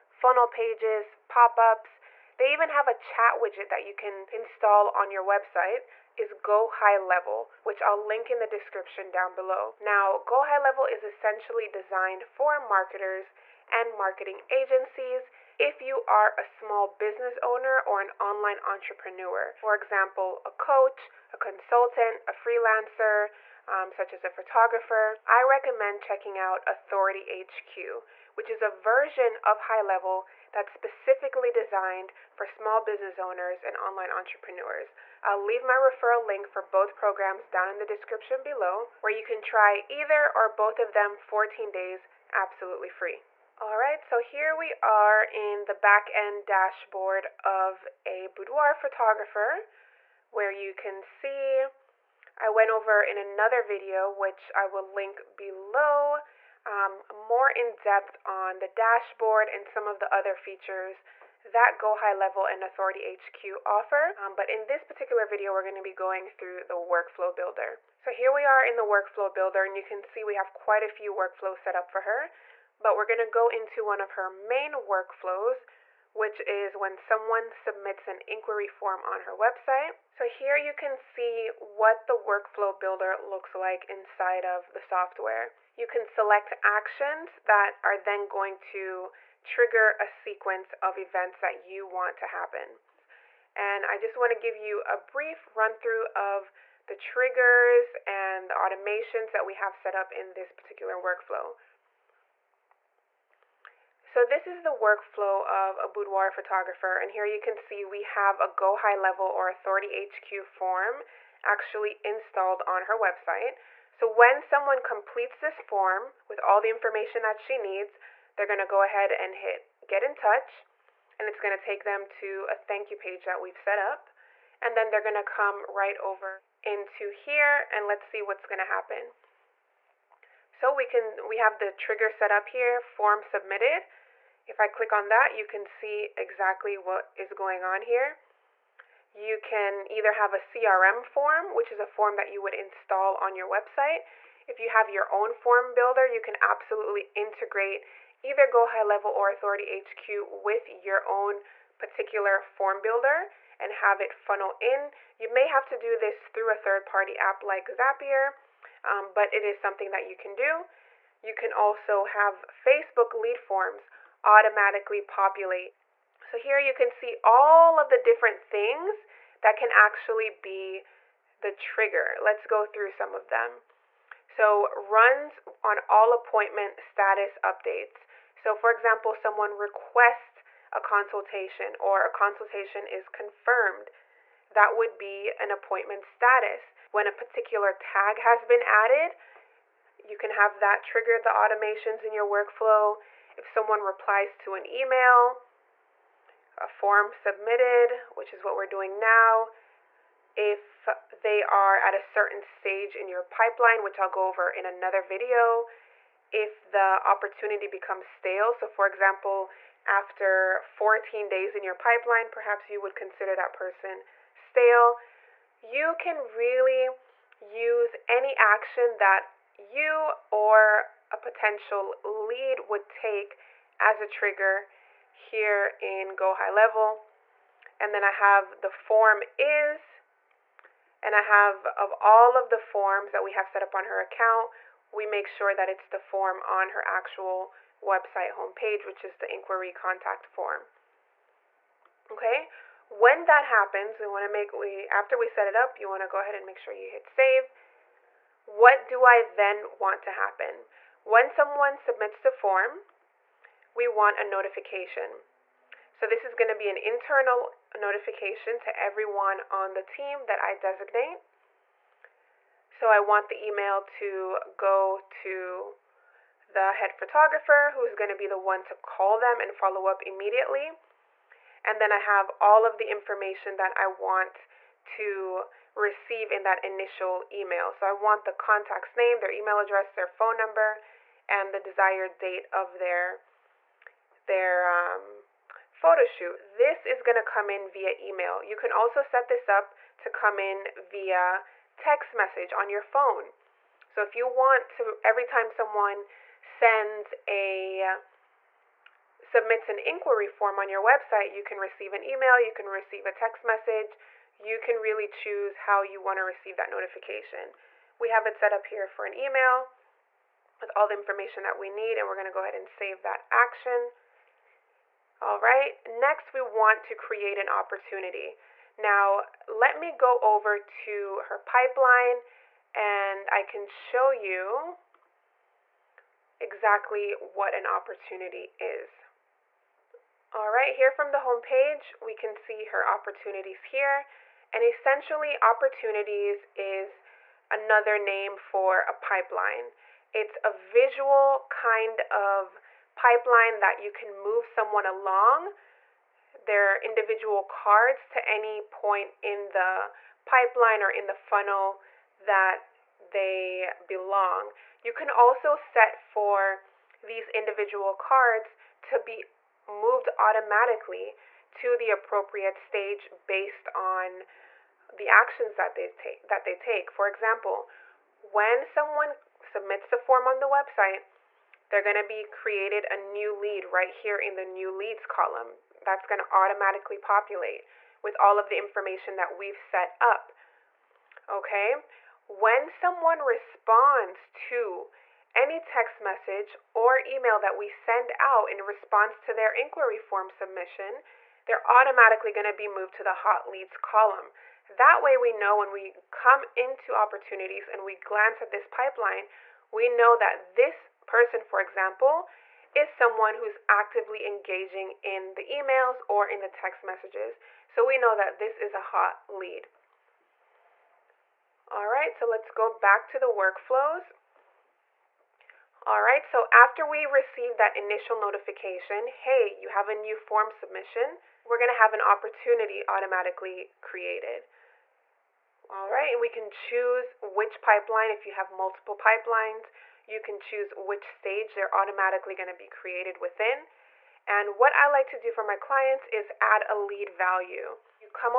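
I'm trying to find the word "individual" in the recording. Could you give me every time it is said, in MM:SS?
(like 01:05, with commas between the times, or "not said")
05:46, 05:57.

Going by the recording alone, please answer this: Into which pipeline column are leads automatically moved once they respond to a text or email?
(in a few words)
Hot leads.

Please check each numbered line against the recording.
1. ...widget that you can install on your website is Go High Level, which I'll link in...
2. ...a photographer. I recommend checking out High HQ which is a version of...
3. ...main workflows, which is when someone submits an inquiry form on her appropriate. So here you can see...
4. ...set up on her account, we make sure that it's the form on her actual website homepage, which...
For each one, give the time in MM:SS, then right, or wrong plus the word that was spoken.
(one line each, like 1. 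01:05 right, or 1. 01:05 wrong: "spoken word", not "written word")
1. 00:03 right
2. 00:24 wrong: "Authority", not "High"
3. 01:14 wrong: "website", not "appropriate"
4. 03:53 right.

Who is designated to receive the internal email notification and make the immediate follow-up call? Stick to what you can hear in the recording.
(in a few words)
The head photographer.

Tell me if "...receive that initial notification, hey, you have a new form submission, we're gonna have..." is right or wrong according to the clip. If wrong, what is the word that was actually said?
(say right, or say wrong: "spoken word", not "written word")
right.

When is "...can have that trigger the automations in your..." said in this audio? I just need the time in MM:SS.
03:10.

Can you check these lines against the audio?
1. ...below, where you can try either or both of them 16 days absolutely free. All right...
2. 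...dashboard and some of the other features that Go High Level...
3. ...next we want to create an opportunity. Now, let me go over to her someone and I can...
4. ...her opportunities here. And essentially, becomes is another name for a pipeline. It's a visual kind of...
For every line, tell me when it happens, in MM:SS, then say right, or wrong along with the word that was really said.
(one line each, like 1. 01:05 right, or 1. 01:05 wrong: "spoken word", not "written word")
1. 00:38 wrong: "14", not "16"
2. 00:58 right
3. 05:15 wrong: "pipeline", not "someone"
4. 05:32 wrong: "opportunities", not "becomes".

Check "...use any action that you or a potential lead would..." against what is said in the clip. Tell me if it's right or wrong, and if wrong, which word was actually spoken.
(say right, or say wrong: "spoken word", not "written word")
right.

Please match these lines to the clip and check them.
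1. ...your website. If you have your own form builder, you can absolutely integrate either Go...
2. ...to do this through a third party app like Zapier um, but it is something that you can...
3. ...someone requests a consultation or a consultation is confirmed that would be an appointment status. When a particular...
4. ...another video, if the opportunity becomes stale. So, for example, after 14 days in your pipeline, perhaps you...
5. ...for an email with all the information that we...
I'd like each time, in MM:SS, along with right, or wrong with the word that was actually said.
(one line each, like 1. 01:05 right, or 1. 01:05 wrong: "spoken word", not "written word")
1. 02:23 right
2. 02:35 right
3. 02:59 right
4. 03:24 right
5. 05:08 right.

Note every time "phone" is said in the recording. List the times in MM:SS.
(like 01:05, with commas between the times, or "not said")
04:40, 04:52.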